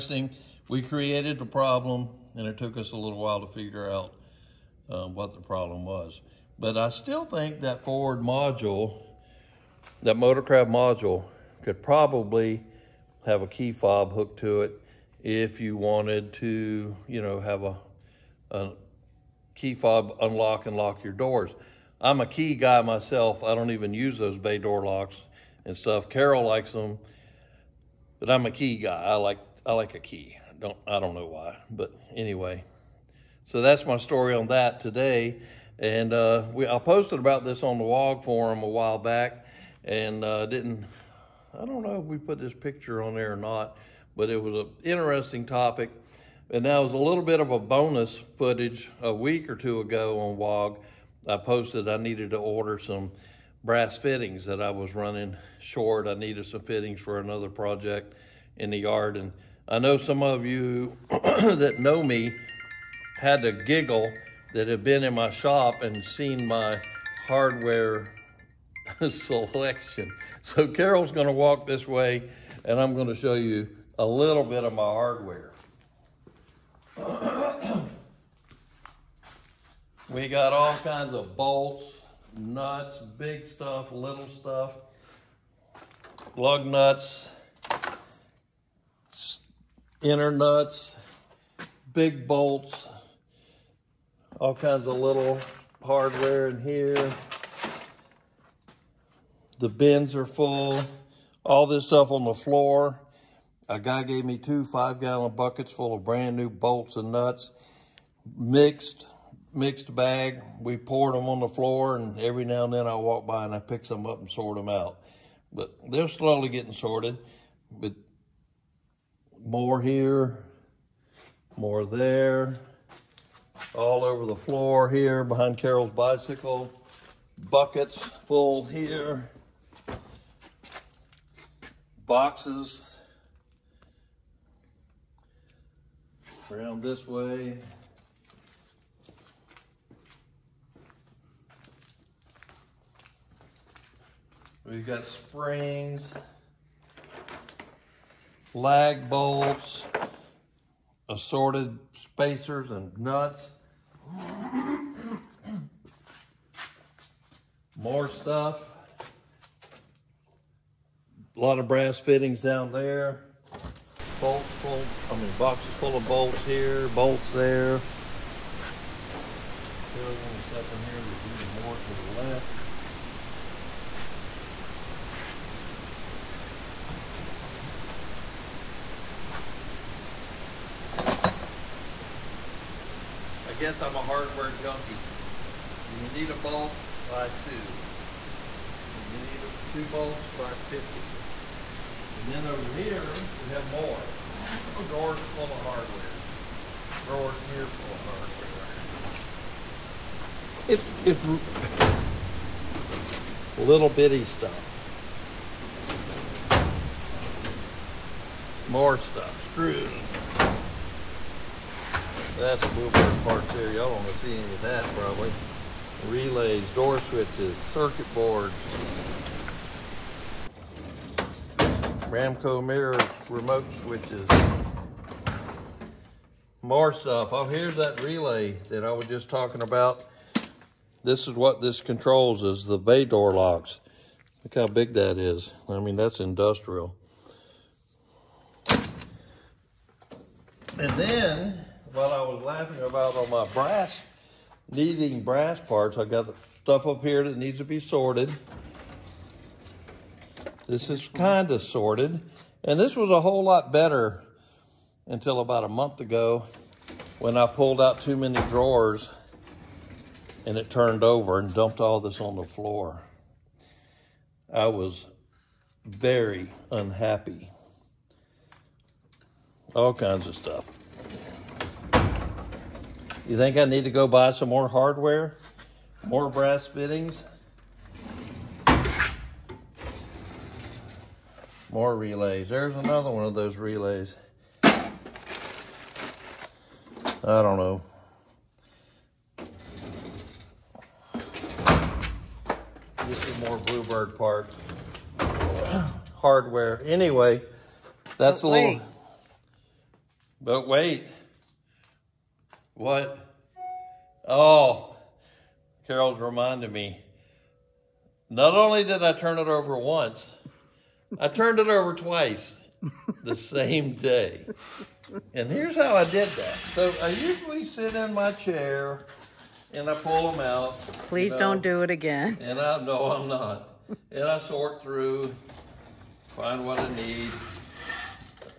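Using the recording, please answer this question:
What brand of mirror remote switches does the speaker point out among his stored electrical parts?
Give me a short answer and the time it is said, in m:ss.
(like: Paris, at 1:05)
Ramco, at 3:42.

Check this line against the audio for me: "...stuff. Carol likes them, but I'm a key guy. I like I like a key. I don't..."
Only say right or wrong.
right.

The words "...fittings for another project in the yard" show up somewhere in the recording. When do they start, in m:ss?
0:56.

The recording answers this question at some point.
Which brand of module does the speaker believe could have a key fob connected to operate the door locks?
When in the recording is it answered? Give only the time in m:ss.
0:10.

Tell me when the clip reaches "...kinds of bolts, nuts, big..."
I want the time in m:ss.
1:20.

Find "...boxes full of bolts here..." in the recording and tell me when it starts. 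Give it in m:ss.
2:45.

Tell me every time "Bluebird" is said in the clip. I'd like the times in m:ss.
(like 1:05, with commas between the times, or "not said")
3:32, 4:53.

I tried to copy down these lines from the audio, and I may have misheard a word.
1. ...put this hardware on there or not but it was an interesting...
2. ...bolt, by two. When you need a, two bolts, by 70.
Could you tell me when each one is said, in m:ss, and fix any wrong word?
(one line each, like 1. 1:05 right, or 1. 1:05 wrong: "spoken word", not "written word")
1. 0:42 wrong: "picture", not "hardware"
2. 3:06 wrong: "50", not "70".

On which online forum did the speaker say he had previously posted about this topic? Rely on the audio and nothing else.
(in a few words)
WOG forum.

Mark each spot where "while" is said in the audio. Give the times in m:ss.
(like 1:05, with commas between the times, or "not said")
0:03, 0:38, 4:01.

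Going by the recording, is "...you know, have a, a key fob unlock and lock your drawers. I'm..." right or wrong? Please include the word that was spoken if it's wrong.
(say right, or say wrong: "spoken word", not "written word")
wrong: "doors", not "drawers".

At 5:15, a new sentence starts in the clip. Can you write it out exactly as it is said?
And here's how I did that.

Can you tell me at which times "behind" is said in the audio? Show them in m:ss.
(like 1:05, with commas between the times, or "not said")
2:05.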